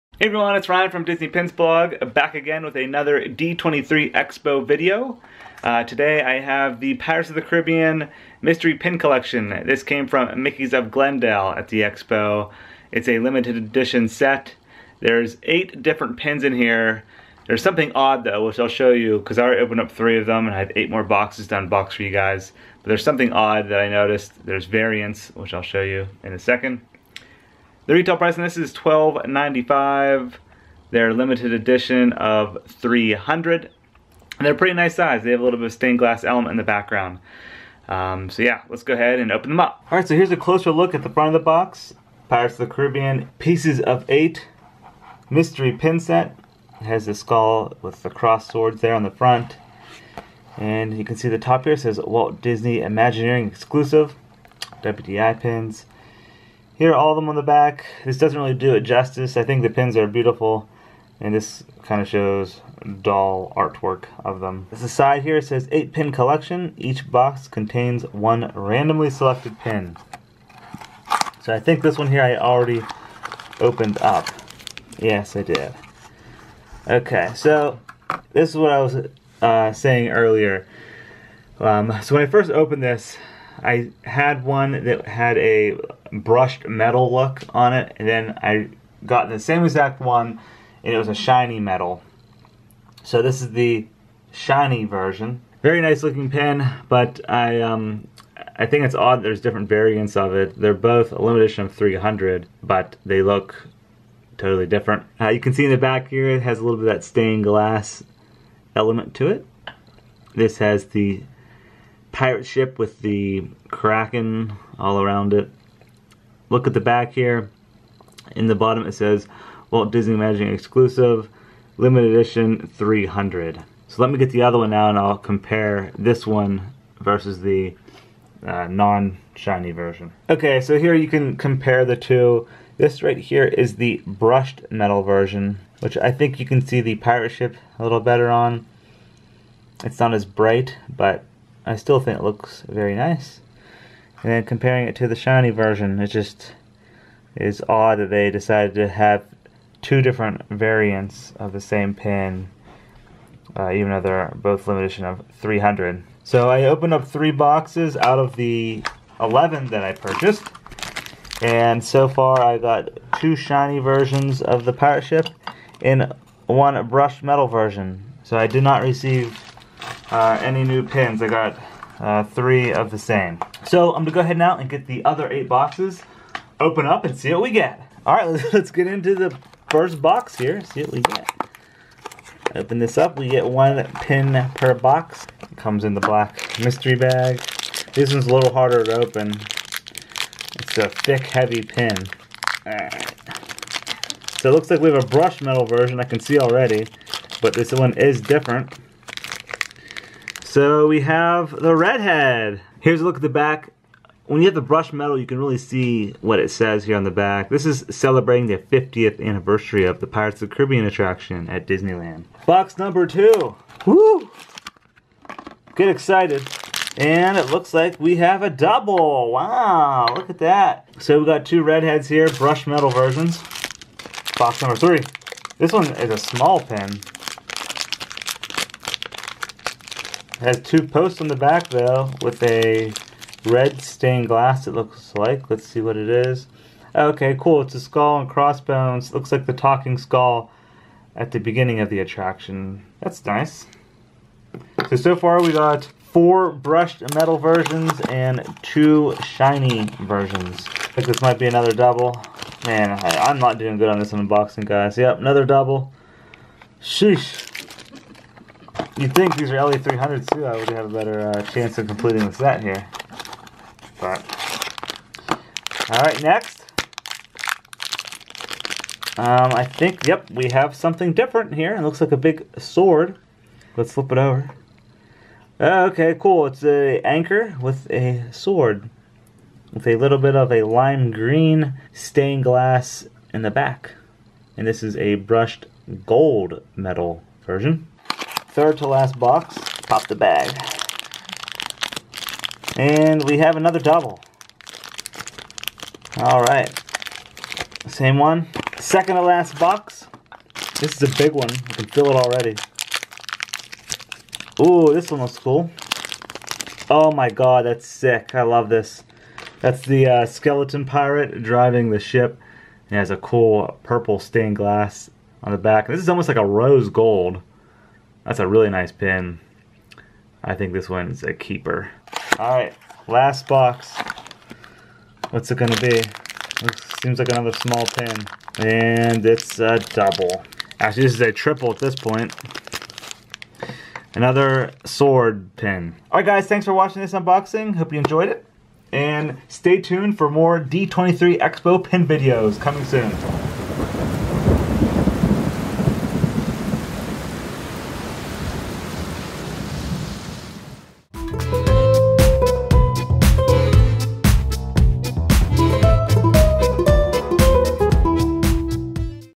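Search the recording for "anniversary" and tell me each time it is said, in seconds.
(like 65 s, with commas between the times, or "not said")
209 s.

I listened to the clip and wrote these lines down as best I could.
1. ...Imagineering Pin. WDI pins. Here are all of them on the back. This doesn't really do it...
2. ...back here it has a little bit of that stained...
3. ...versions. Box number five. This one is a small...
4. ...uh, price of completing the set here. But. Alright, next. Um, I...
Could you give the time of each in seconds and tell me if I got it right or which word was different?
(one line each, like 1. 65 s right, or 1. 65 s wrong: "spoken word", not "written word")
1. 52 s wrong: "Exclusive", not "Pin"
2. 105 s right
3. 222 s wrong: "three", not "five"
4. 261 s wrong: "chance", not "price".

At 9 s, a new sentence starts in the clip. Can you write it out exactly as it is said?
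This came from Mickey's of Glendale at the Expo.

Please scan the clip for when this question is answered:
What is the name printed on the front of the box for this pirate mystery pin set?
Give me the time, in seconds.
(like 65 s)
43 s.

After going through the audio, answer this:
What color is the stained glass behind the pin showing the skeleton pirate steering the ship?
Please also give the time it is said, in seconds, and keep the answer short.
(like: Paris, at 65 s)
purple, at 313 s.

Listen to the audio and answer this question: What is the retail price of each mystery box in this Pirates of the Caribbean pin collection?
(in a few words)
$12.95.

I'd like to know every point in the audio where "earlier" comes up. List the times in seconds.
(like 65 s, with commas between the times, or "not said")
80 s.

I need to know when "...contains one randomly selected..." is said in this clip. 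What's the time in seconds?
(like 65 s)
67 s.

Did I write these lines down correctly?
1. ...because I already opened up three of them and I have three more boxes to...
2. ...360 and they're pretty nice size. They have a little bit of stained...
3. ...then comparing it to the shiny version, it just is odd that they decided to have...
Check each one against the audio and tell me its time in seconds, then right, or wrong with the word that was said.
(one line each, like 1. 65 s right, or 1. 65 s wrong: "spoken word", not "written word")
1. 19 s wrong: "eight", not "three"
2. 32 s wrong: "300", not "360"
3. 144 s right.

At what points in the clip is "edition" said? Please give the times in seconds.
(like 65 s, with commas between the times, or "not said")
13 s, 31 s, 101 s, 122 s, 154 s.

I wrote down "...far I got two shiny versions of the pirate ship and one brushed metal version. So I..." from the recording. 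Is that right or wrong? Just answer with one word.
right.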